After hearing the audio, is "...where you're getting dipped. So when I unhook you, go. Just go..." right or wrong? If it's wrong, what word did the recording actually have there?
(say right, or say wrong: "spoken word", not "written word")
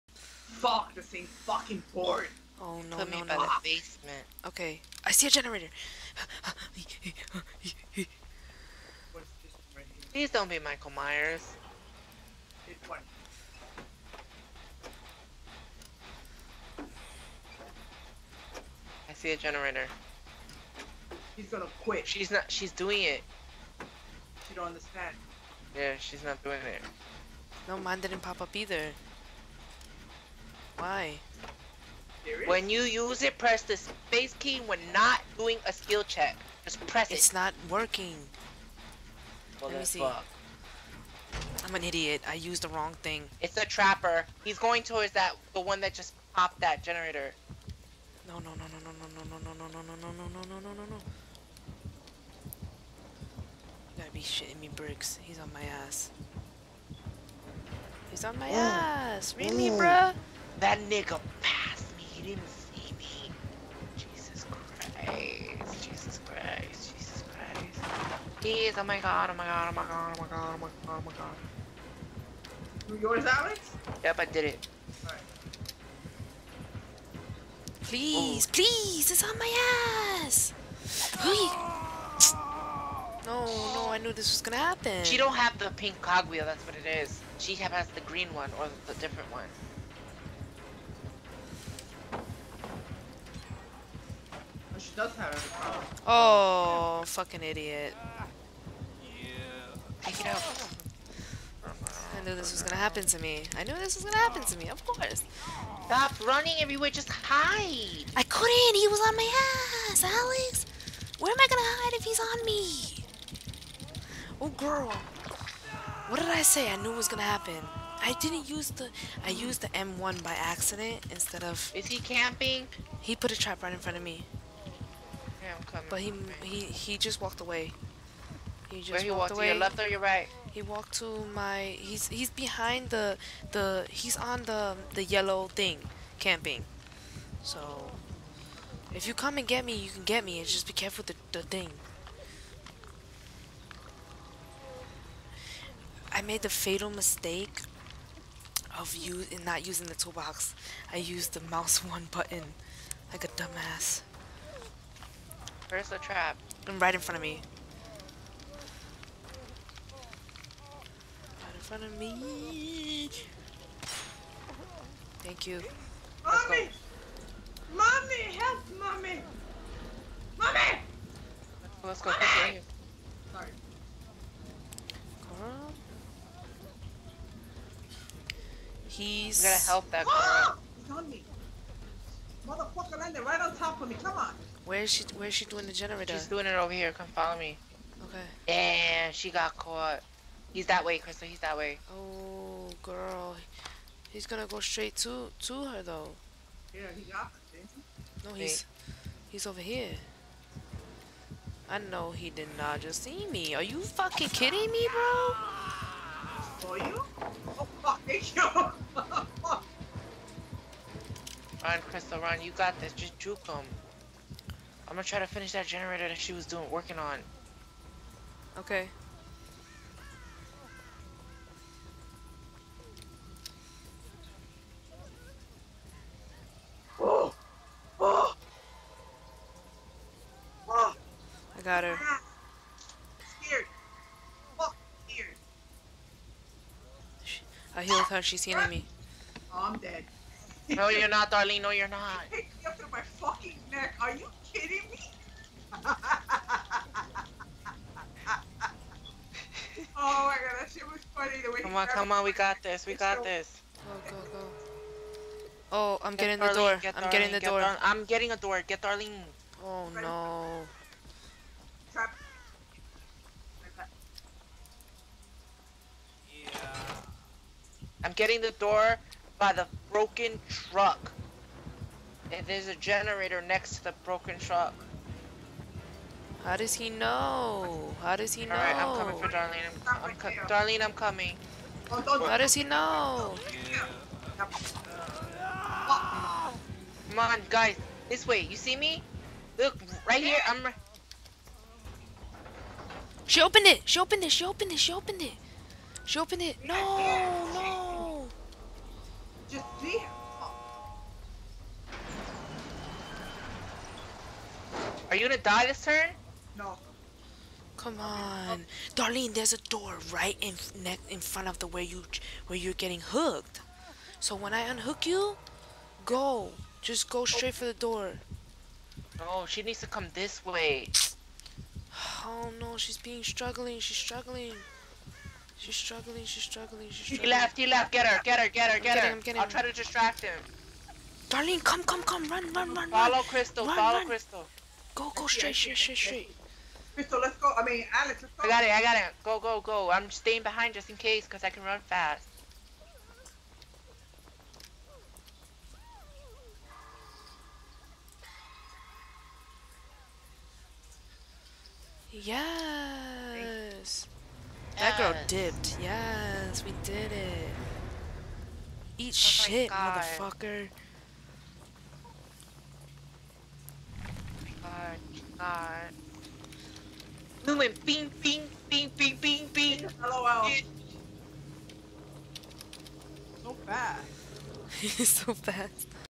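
wrong: "hooked", not "dipped".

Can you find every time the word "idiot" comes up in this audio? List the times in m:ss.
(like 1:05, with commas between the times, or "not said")
0:41, 1:37.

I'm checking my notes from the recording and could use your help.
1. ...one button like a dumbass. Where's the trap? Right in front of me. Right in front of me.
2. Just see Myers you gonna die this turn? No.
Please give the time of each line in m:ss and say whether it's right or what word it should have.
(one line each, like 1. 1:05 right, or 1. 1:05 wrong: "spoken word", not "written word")
1. 2:31 right
2. 4:59 wrong: "Are", not "Myers".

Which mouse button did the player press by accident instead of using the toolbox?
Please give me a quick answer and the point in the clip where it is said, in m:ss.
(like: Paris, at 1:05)
M1, at 1:59.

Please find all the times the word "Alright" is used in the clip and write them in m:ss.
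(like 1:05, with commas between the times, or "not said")
4:38.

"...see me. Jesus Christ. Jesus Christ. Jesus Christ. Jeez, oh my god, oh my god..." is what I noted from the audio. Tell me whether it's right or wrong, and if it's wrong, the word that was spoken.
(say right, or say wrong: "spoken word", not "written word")
right.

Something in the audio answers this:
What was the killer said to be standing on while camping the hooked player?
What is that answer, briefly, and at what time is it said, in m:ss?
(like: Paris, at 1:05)
The yellow thing, at 2:15.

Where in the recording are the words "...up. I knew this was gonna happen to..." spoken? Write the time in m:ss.
1:40.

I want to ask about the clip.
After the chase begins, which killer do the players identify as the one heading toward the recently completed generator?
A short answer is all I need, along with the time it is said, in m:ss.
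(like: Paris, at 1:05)
Trapper, at 0:43.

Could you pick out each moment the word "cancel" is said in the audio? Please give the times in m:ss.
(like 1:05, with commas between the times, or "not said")
not said.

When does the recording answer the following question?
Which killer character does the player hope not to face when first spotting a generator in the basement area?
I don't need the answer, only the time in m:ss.
0:10.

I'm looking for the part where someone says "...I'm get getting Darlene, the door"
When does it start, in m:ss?
4:16.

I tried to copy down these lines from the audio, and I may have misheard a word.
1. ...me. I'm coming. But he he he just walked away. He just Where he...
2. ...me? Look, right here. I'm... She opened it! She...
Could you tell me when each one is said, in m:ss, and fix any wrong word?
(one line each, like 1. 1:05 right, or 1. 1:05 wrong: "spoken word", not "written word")
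1. 2:04 right
2. 4:48 right.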